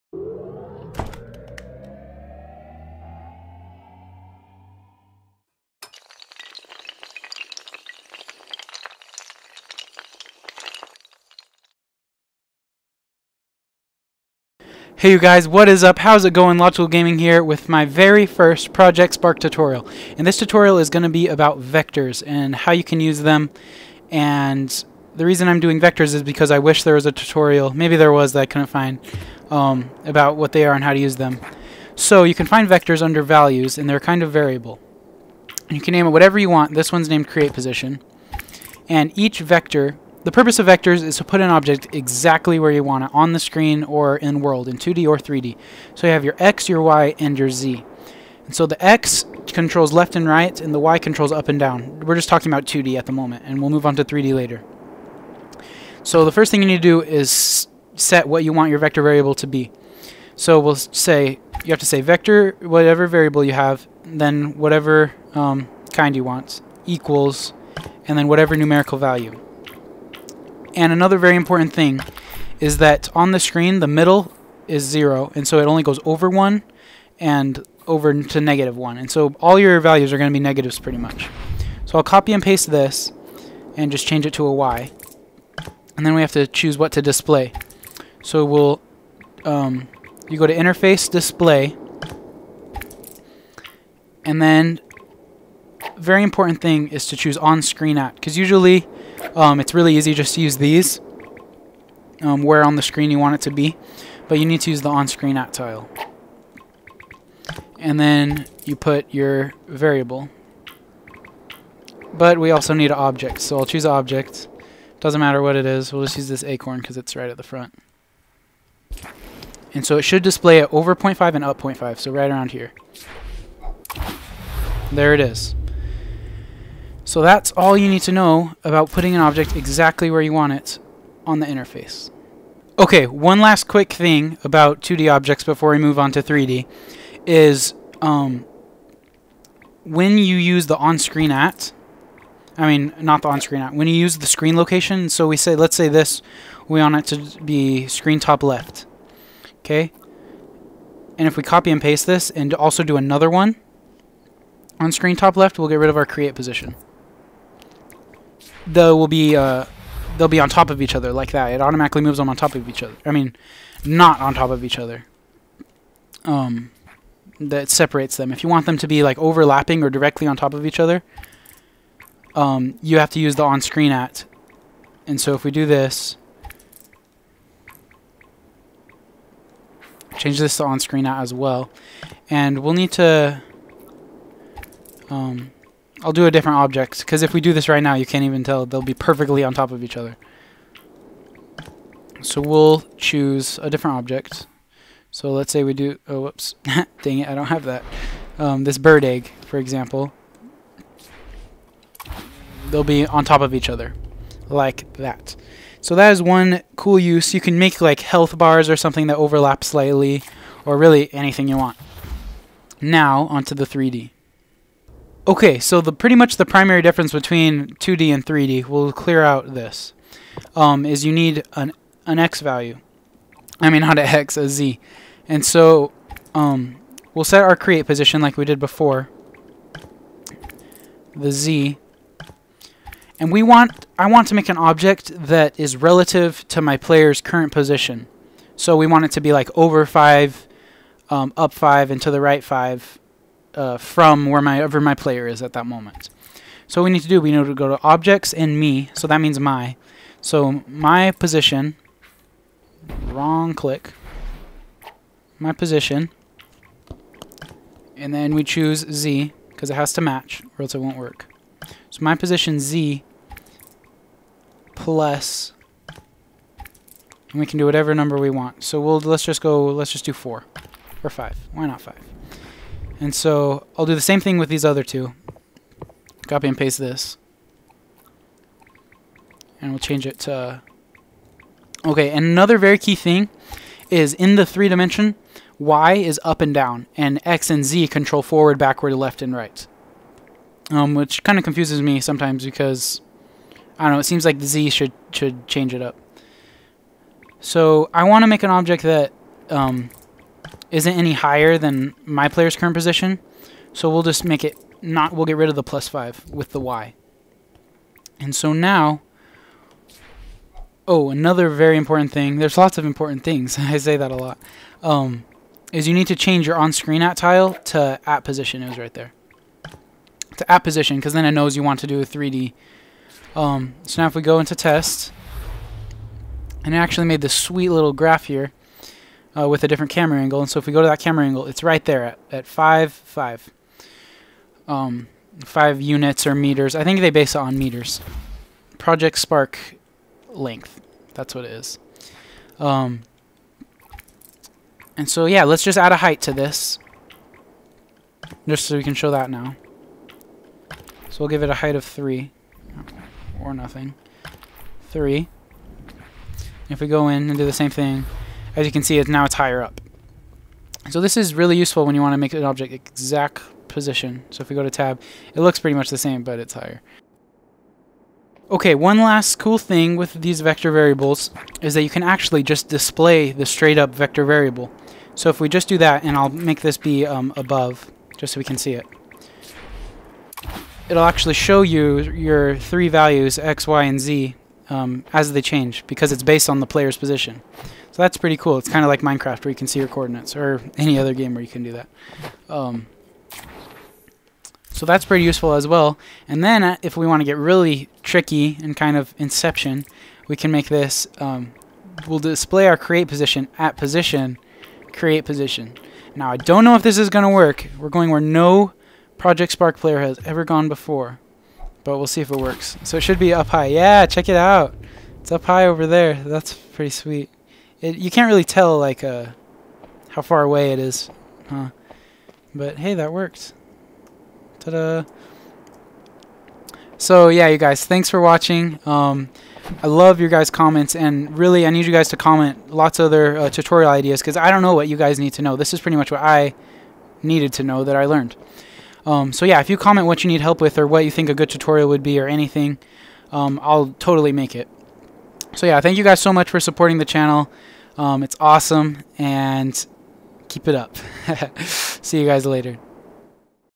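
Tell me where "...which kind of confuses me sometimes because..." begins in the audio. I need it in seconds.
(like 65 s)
290 s.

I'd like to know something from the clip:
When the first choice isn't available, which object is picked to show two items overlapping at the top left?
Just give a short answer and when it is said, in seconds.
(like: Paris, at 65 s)
Bird egg, at 198 s.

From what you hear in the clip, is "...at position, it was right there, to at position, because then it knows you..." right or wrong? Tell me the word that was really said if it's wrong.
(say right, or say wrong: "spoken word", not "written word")
right.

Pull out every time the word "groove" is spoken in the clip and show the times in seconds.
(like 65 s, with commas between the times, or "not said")
not said.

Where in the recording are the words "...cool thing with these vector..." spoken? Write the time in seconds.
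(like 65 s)
369 s.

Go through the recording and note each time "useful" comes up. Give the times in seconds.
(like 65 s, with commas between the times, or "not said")
361 s, 395 s.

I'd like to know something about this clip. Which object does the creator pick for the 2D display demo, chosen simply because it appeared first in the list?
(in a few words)
Acorn.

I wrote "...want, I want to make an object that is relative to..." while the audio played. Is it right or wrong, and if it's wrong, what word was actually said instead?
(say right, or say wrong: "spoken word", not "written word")
right.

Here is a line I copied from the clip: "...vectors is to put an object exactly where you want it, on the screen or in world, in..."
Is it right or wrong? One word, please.
right.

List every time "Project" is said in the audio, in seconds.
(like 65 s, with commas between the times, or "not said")
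18 s, 338 s, 409 s.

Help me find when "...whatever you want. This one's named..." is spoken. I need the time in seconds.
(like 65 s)
36 s.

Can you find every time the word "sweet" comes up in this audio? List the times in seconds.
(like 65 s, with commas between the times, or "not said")
327 s, 416 s.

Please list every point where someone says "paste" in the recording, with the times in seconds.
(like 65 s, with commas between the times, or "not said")
82 s, 151 s, 276 s.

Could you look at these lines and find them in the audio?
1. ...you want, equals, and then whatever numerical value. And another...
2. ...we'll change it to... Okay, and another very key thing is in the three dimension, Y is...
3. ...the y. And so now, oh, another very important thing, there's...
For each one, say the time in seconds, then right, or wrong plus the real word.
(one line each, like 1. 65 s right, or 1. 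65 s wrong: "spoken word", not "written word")
1. 66 s right
2. 279 s right
3. 306 s right.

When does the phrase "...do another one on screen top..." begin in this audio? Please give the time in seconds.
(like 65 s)
152 s.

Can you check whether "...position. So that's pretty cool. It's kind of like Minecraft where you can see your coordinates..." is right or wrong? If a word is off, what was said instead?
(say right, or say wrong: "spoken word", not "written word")
right.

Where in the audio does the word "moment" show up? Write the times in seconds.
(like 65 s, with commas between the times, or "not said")
53 s, 245 s.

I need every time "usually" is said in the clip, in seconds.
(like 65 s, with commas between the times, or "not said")
98 s.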